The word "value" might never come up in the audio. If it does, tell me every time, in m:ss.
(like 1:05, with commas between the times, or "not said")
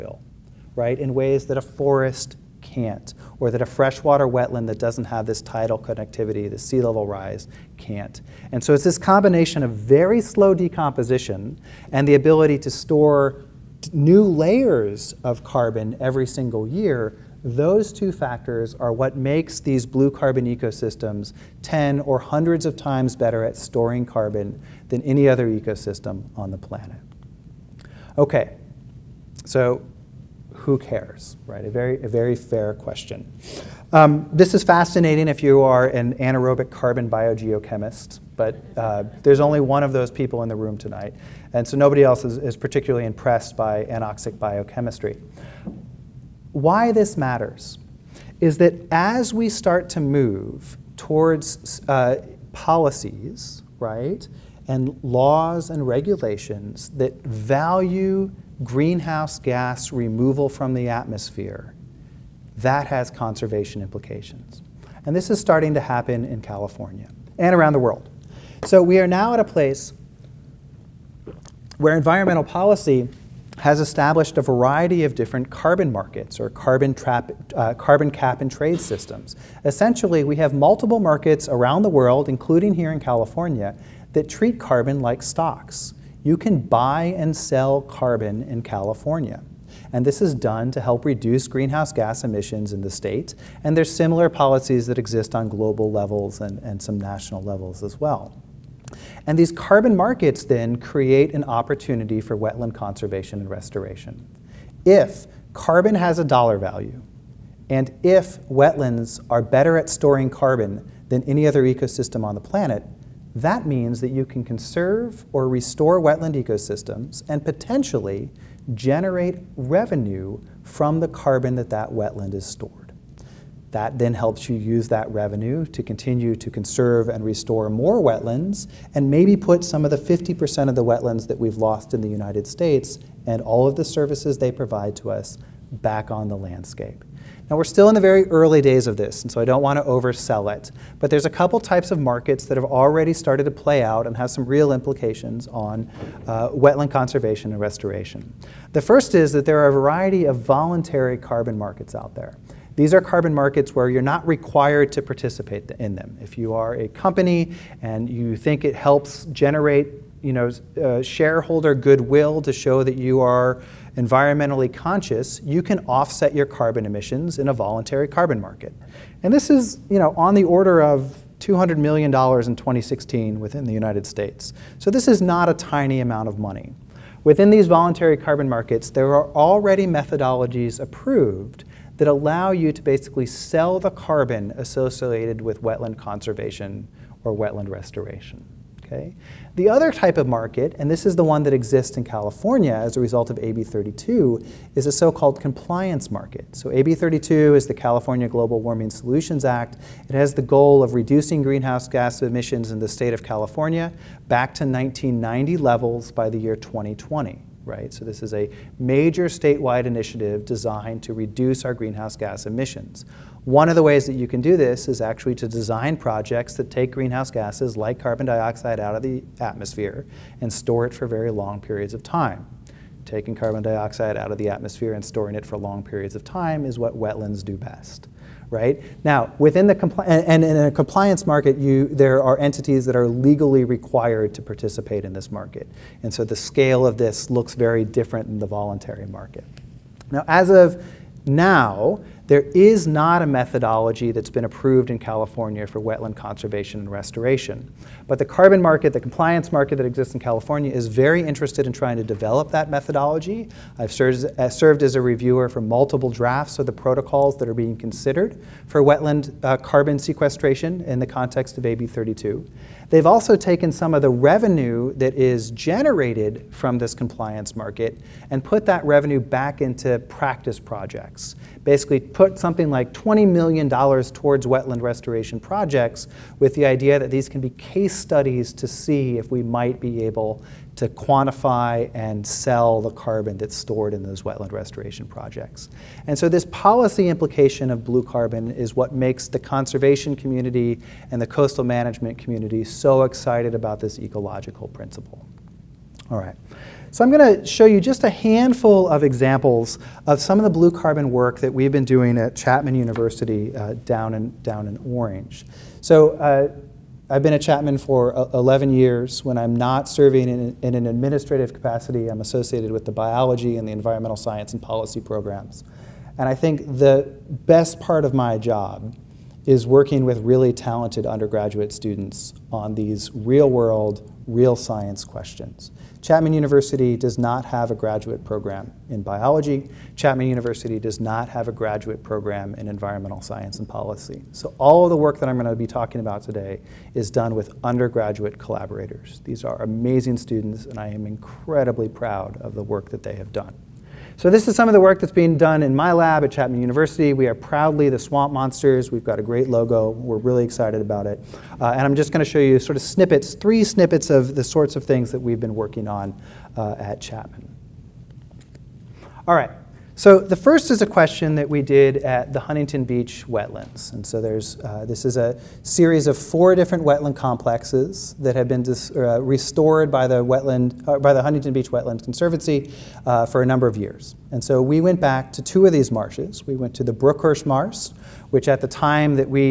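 0:57, 1:46.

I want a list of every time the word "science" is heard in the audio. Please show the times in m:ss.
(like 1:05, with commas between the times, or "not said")
5:14, 5:24, 5:33.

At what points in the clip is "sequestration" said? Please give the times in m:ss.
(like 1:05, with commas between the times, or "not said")
4:19.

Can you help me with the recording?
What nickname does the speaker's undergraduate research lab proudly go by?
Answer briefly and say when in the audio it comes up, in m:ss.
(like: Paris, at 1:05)
Swamp Monsters, at 5:47.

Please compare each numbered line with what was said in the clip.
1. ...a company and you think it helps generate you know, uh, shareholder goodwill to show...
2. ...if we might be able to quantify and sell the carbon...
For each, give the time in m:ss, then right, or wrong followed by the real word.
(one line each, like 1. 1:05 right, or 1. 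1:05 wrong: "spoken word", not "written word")
1. 2:36 right
2. 4:39 right.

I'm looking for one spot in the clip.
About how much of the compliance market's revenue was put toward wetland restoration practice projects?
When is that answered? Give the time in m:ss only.
4:32.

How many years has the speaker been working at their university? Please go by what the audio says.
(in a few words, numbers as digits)
11 years.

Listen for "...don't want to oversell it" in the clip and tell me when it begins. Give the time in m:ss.
2:19.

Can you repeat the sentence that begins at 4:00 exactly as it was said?
Now, as of now, there is not a methodology that's been approved in California for wetland conservation and restoration.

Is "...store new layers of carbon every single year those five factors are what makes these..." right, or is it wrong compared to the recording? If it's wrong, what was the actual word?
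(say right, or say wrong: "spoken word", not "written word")
wrong: "two", not "five".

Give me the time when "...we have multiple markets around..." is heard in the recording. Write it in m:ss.
1:20.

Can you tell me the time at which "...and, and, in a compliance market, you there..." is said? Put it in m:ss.
3:50.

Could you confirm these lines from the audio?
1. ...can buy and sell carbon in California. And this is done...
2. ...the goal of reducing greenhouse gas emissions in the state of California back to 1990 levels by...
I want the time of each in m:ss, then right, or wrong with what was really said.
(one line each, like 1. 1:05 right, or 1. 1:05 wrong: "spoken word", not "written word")
1. 1:26 right
2. 3:20 right.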